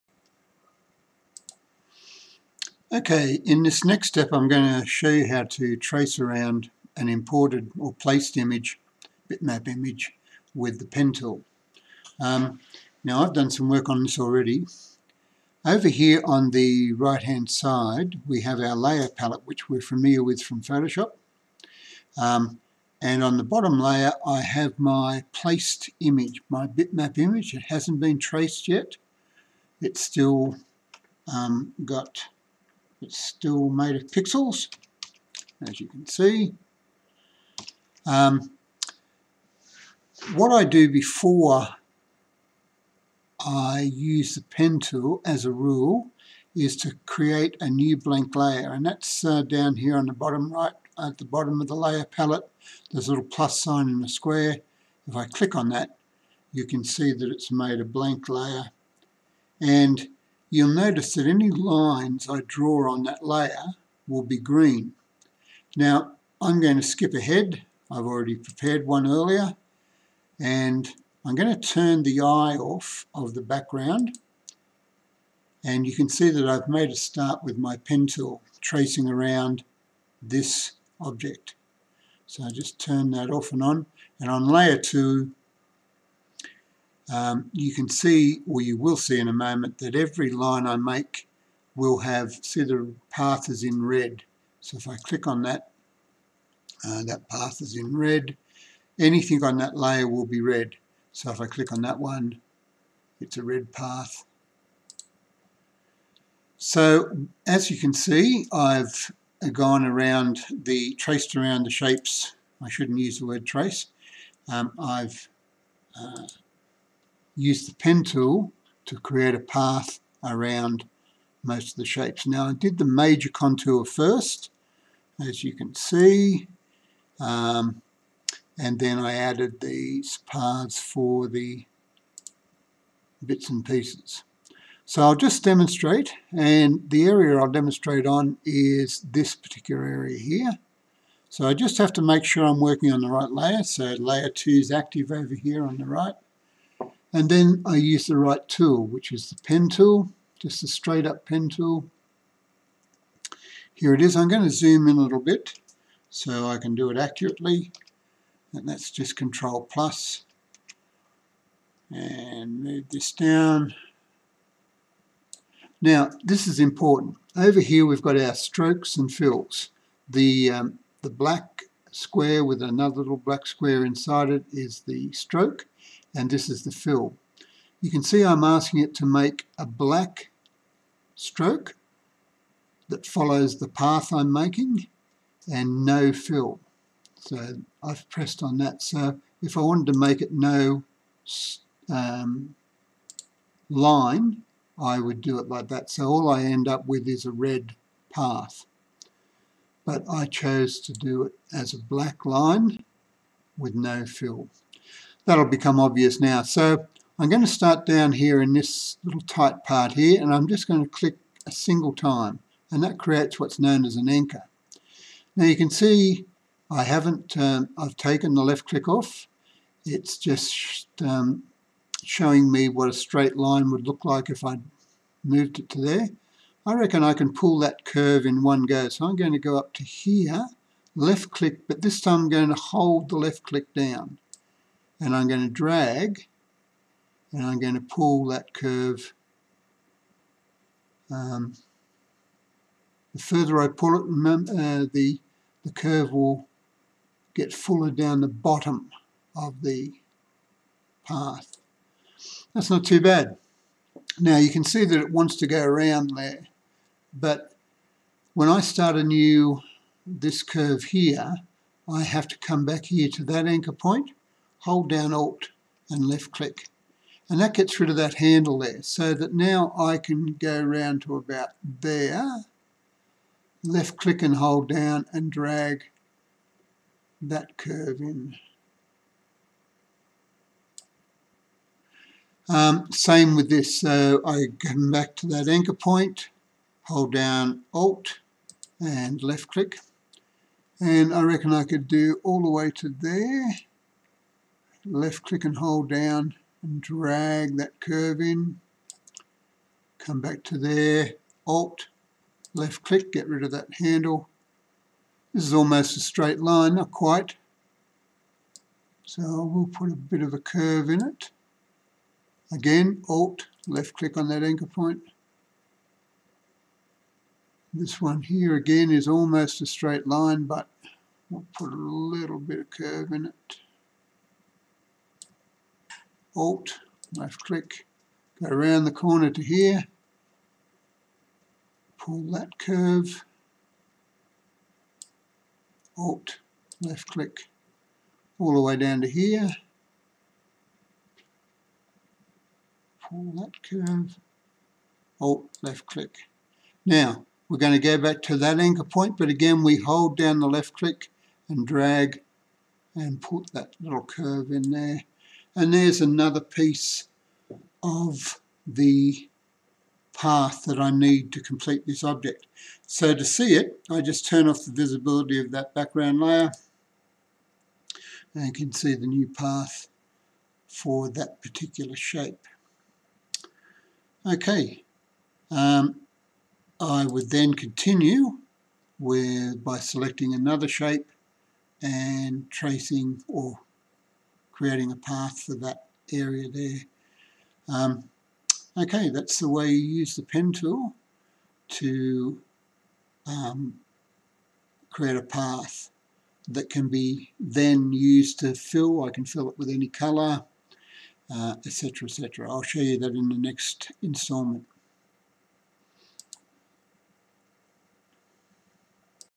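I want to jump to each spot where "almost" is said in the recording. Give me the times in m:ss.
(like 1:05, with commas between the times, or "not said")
5:05, 5:19.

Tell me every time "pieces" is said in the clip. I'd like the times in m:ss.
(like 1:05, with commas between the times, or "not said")
2:13, 5:56.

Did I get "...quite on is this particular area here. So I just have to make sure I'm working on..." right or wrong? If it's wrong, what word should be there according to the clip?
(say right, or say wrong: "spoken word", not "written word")
wrong: "demonstrate", not "quite".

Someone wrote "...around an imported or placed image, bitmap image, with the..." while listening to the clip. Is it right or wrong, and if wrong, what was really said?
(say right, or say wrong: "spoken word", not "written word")
right.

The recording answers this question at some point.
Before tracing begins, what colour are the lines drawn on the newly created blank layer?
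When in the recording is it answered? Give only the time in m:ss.
1:04.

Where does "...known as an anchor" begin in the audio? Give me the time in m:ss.
3:33.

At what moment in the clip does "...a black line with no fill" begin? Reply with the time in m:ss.
3:21.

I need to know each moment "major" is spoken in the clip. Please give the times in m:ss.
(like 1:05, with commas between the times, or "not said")
2:02.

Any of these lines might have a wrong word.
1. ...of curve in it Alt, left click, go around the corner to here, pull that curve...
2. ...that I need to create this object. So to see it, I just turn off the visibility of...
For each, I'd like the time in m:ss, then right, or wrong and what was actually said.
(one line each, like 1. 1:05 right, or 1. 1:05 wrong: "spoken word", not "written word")
1. 5:22 right
2. 6:00 wrong: "complete", not "create".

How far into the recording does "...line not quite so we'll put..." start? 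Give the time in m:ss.
5:06.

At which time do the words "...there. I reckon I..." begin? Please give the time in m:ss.
3:45.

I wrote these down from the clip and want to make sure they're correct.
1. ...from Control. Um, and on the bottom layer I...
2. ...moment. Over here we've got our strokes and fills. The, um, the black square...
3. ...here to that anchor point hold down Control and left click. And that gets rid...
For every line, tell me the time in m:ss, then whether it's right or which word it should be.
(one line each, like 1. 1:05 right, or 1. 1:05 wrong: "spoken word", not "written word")
1. 0:20 wrong: "Photoshop", not "Control"
2. 2:46 wrong: "important", not "moment"
3. 4:22 wrong: "Alt", not "Control".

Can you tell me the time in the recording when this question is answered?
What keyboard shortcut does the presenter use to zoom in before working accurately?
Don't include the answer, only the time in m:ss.
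2:39.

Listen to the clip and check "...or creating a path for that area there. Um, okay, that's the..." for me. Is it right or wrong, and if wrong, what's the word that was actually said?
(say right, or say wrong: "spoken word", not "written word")
right.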